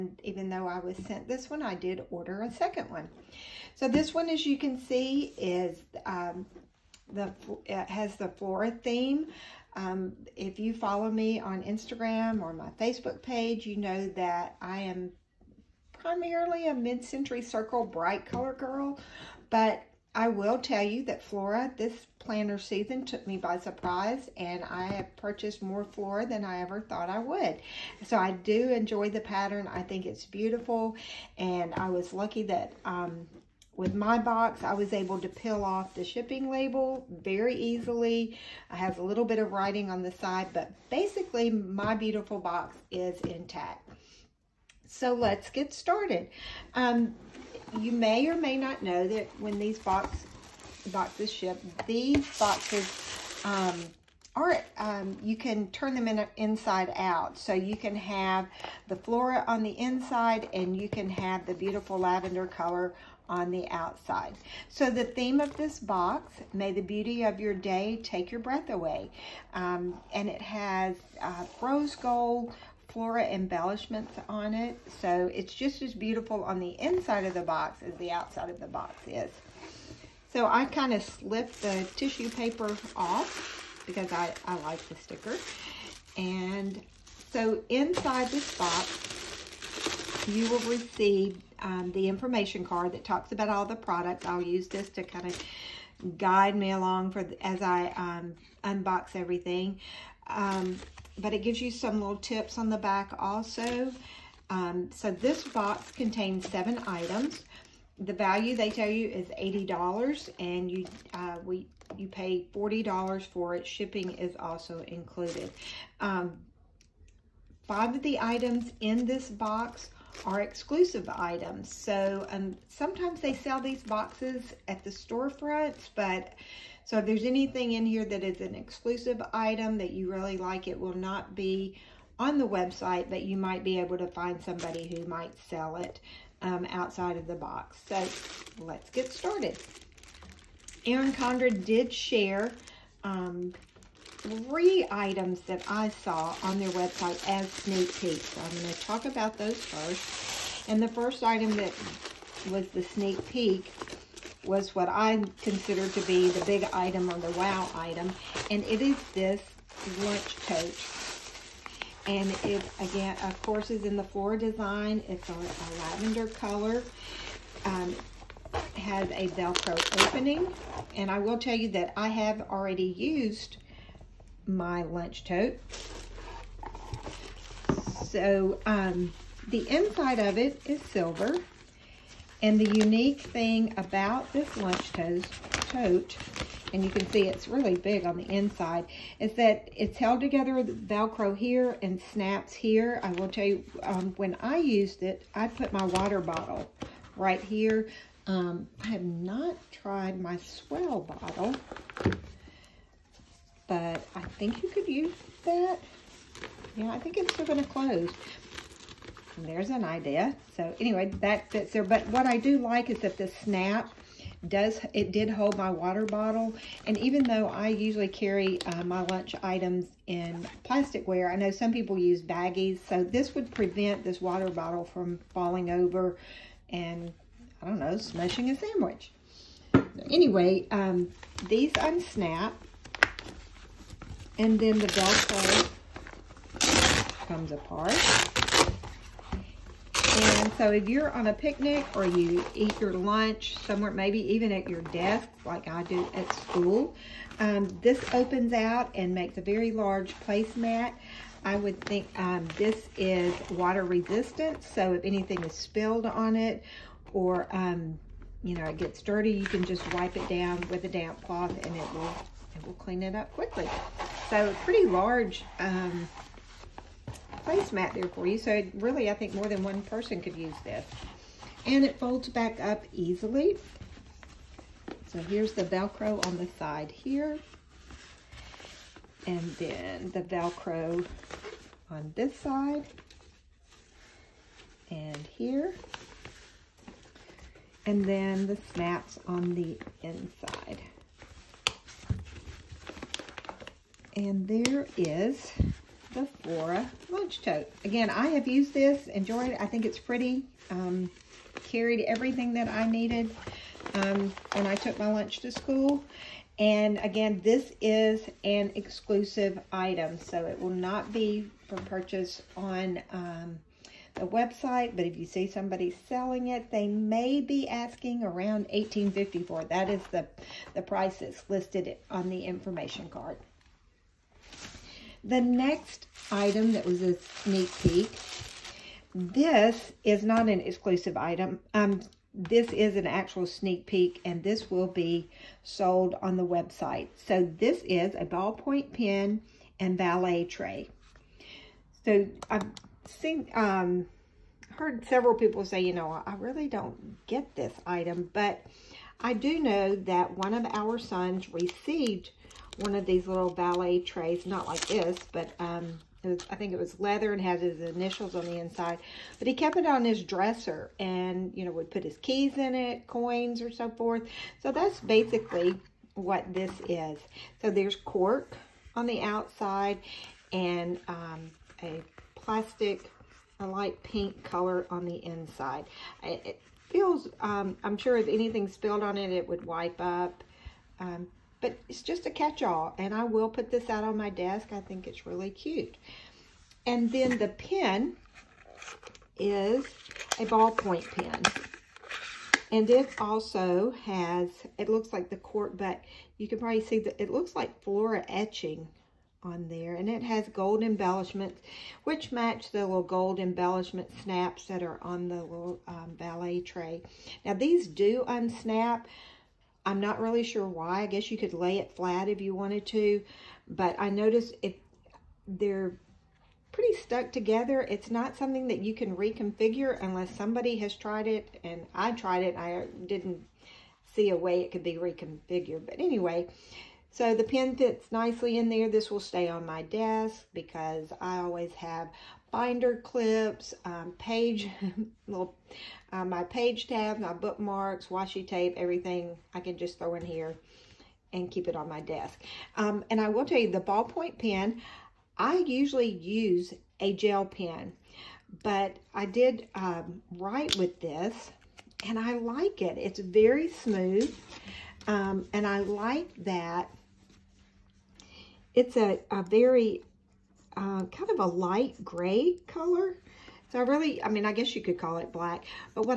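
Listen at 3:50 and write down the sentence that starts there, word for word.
Anyway, um, these unsnap and then the Velcro comes apart.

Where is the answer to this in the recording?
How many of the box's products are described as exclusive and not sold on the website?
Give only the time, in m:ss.
1:57.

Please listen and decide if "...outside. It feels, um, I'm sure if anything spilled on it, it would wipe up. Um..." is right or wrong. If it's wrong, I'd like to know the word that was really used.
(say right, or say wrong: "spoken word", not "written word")
wrong: "inside", not "outside".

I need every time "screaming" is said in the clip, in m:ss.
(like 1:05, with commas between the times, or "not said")
not said.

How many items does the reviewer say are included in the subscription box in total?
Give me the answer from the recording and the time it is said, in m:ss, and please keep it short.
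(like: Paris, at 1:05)
7, at 1:46.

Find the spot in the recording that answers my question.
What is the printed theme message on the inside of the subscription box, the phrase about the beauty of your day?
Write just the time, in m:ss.
1:06.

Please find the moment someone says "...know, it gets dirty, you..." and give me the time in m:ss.
4:18.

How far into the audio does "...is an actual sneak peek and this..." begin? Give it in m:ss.
5:32.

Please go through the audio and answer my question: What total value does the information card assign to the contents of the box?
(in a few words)
$80.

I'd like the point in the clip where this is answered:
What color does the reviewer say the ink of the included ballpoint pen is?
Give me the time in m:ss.
7:41.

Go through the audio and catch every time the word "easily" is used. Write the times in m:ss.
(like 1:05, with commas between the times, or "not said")
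0:37, 4:32.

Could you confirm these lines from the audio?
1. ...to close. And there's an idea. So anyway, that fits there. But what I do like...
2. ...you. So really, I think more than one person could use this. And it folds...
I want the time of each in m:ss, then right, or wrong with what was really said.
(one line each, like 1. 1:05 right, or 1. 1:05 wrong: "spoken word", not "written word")
1. 3:27 right
2. 4:28 right.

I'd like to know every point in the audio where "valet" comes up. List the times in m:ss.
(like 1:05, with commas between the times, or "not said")
5:39, 5:53, 6:46.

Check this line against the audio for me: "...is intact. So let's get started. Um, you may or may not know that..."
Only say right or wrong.
right.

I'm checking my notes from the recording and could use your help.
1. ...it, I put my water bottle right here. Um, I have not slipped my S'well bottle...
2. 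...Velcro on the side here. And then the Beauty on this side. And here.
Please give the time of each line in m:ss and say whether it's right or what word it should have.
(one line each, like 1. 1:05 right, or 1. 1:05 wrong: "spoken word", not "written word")
1. 3:15 wrong: "tried", not "slipped"
2. 4:35 wrong: "Velcro", not "Beauty".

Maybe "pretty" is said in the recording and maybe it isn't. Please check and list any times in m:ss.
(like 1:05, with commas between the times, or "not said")
4:24, 4:59, 6:56.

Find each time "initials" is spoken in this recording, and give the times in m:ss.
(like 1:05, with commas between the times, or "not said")
5:57.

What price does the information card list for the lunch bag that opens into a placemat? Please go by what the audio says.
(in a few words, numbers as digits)
$18.54.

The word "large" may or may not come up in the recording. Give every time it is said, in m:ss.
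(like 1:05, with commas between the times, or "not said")
4:09, 4:24.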